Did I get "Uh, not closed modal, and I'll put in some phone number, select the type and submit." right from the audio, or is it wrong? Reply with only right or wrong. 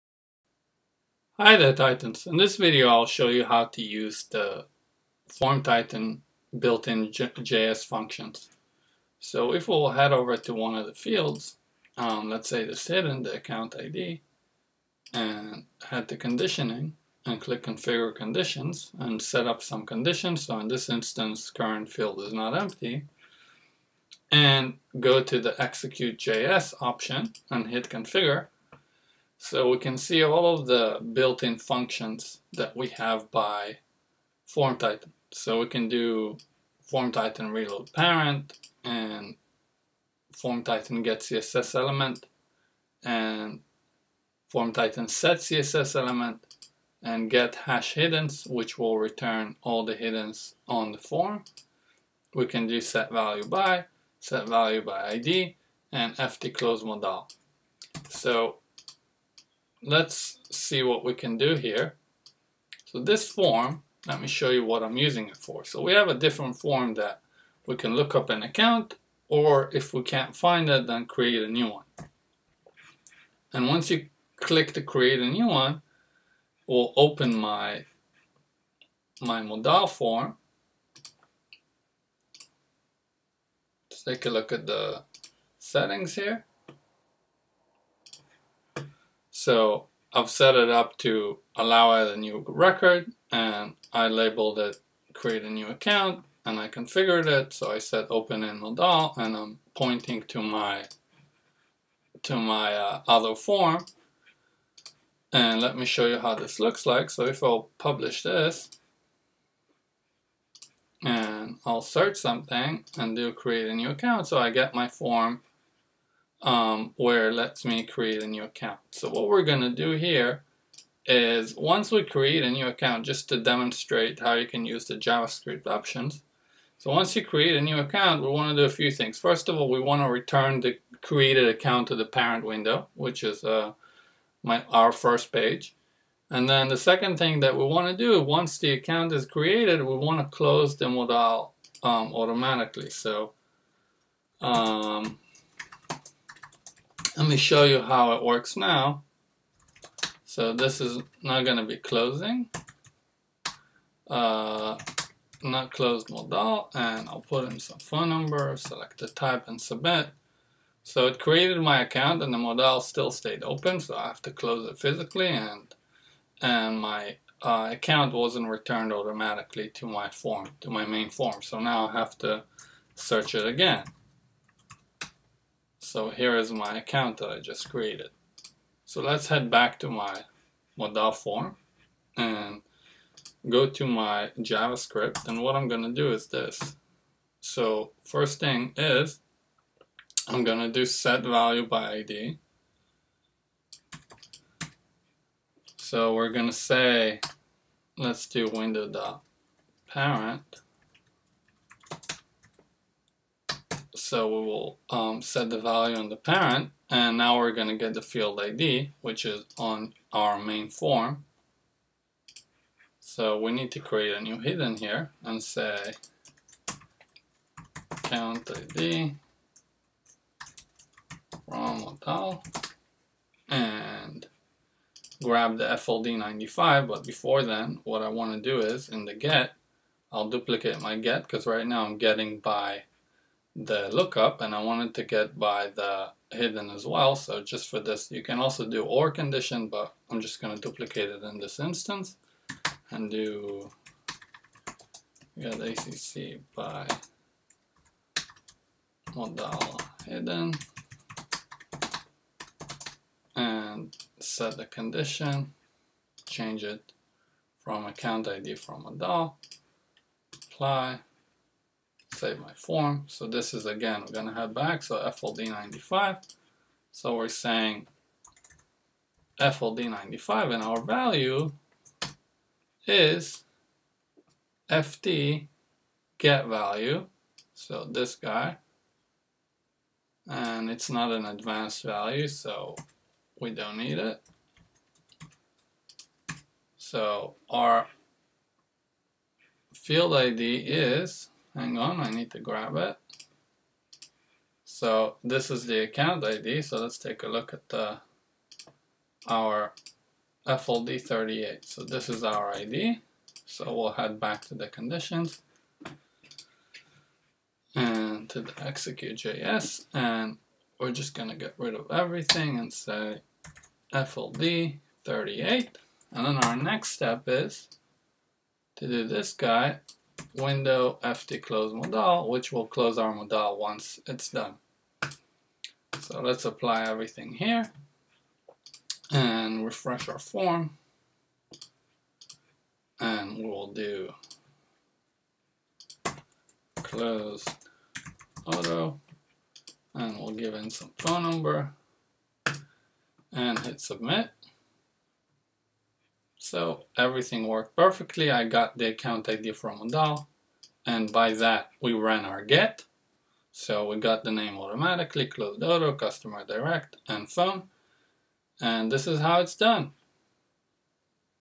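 right.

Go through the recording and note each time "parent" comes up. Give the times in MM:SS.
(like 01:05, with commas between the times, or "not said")
00:37, 02:12, 03:19, 03:26.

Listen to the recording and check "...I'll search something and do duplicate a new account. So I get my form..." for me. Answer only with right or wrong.
wrong.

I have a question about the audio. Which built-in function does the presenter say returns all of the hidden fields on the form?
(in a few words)
get hash hiddens.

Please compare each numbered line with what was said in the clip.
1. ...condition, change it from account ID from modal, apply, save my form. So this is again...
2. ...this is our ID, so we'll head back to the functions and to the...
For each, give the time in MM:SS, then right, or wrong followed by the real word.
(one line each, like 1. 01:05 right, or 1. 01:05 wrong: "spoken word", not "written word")
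1. 04:14 right
2. 05:01 wrong: "conditions", not "functions".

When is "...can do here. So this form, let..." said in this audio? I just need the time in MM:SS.
01:01.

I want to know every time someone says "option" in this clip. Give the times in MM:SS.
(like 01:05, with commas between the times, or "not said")
00:26, 02:05.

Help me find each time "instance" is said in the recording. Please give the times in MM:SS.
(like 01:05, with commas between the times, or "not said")
00:20, 04:01.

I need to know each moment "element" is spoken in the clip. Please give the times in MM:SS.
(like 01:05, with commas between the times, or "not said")
00:41, 00:45.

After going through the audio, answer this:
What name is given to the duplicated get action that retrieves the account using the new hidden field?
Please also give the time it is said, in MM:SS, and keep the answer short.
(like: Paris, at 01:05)
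get ACC by modal hidden, at 04:05.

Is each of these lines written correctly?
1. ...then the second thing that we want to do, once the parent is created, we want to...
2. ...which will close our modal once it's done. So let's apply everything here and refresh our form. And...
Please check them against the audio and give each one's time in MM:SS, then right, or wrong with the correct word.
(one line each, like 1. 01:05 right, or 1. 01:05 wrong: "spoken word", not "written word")
1. 02:16 wrong: "account", not "parent"
2. 05:22 right.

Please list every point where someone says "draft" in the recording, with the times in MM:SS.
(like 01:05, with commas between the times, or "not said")
not said.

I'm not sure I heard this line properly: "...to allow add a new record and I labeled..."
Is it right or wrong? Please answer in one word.
right.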